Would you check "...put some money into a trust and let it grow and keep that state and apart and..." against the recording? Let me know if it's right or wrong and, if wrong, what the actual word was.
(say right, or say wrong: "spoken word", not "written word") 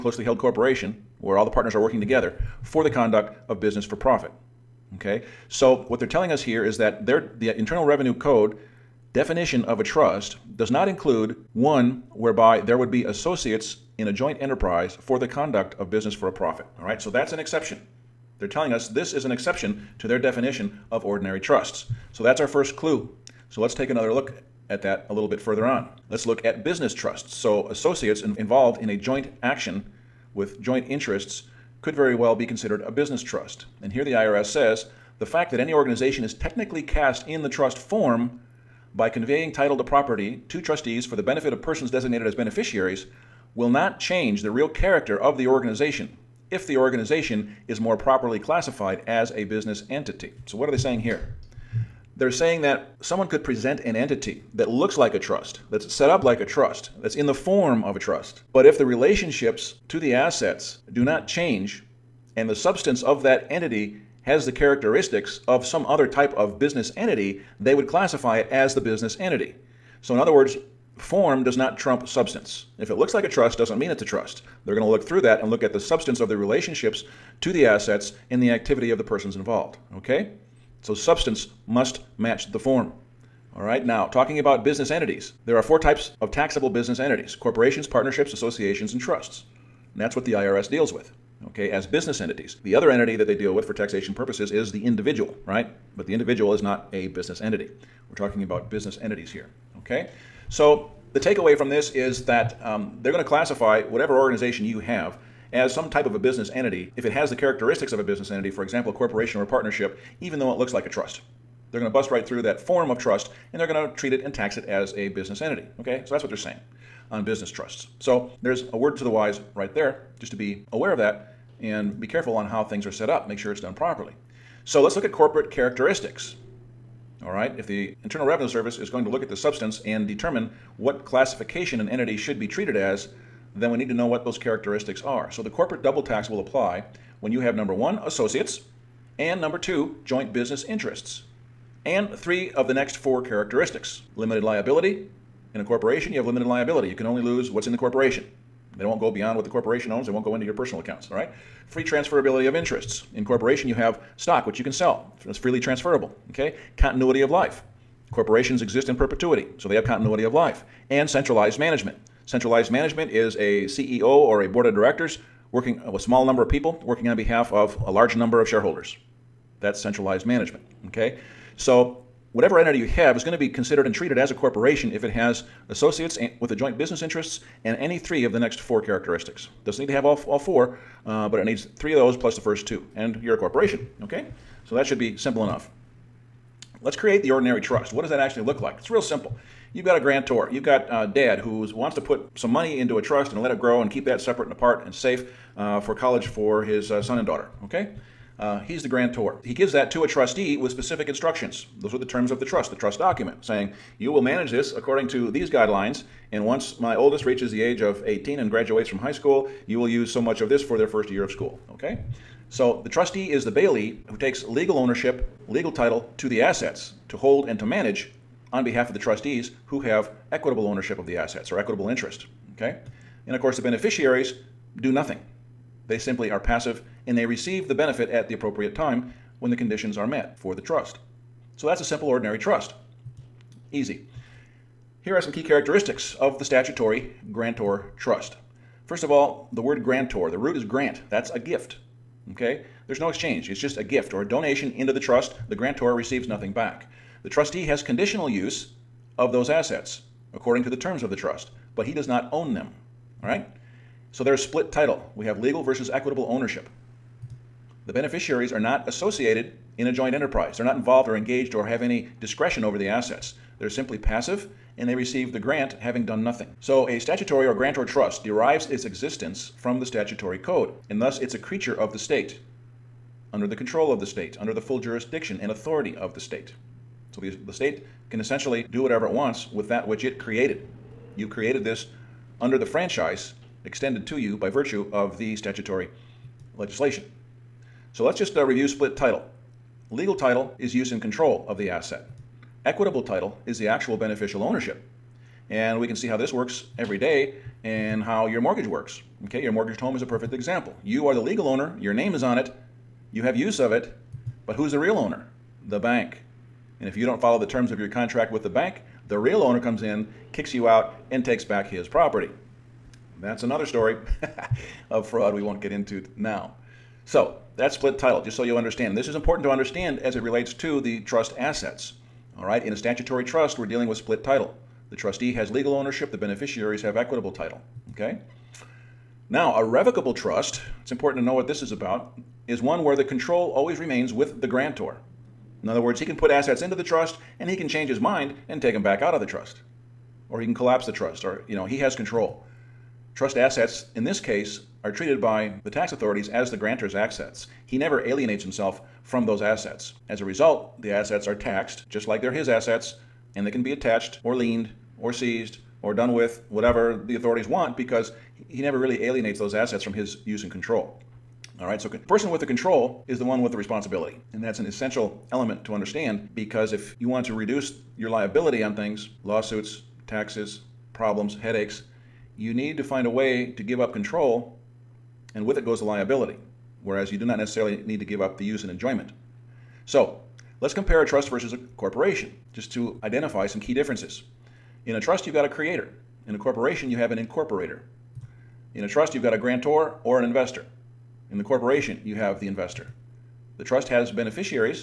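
wrong: "separate", not "state".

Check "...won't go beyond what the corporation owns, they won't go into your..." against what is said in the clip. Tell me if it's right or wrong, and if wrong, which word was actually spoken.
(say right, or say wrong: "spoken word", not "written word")
right.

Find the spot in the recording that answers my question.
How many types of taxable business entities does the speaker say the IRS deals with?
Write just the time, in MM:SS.
01:25.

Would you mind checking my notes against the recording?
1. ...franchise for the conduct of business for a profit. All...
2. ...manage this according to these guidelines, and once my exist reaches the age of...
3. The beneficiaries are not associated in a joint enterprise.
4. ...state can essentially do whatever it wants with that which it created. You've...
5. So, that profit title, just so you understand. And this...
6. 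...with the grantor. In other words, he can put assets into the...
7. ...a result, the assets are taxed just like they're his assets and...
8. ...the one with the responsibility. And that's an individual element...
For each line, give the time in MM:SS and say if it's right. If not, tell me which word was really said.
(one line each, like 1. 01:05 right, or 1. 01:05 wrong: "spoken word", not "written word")
1. 00:14 wrong: "enterprise", not "franchise"
2. 03:24 wrong: "oldest", not "exist"
3. 04:17 right
4. 04:37 right
5. 05:17 wrong: "split", not "profit"
6. 05:34 right
7. 05:50 right
8. 06:03 wrong: "essential", not "individual".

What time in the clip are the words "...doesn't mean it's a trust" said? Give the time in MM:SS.
01:13.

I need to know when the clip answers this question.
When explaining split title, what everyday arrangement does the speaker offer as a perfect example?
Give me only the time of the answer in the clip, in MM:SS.
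04:59.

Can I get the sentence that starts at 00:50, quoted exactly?
So, what are they saying here?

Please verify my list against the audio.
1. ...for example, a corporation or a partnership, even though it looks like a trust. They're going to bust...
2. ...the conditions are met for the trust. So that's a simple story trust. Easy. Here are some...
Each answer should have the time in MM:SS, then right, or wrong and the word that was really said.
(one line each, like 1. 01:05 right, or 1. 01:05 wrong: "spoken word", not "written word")
1. 01:48 right
2. 03:49 wrong: "ordinary", not "story".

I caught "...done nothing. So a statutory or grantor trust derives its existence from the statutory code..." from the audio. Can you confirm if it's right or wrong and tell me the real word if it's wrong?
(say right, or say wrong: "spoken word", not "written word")
right.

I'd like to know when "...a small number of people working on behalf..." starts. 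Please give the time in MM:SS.
02:45.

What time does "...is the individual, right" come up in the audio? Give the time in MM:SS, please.
01:34.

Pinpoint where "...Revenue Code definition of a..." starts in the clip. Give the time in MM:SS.
00:07.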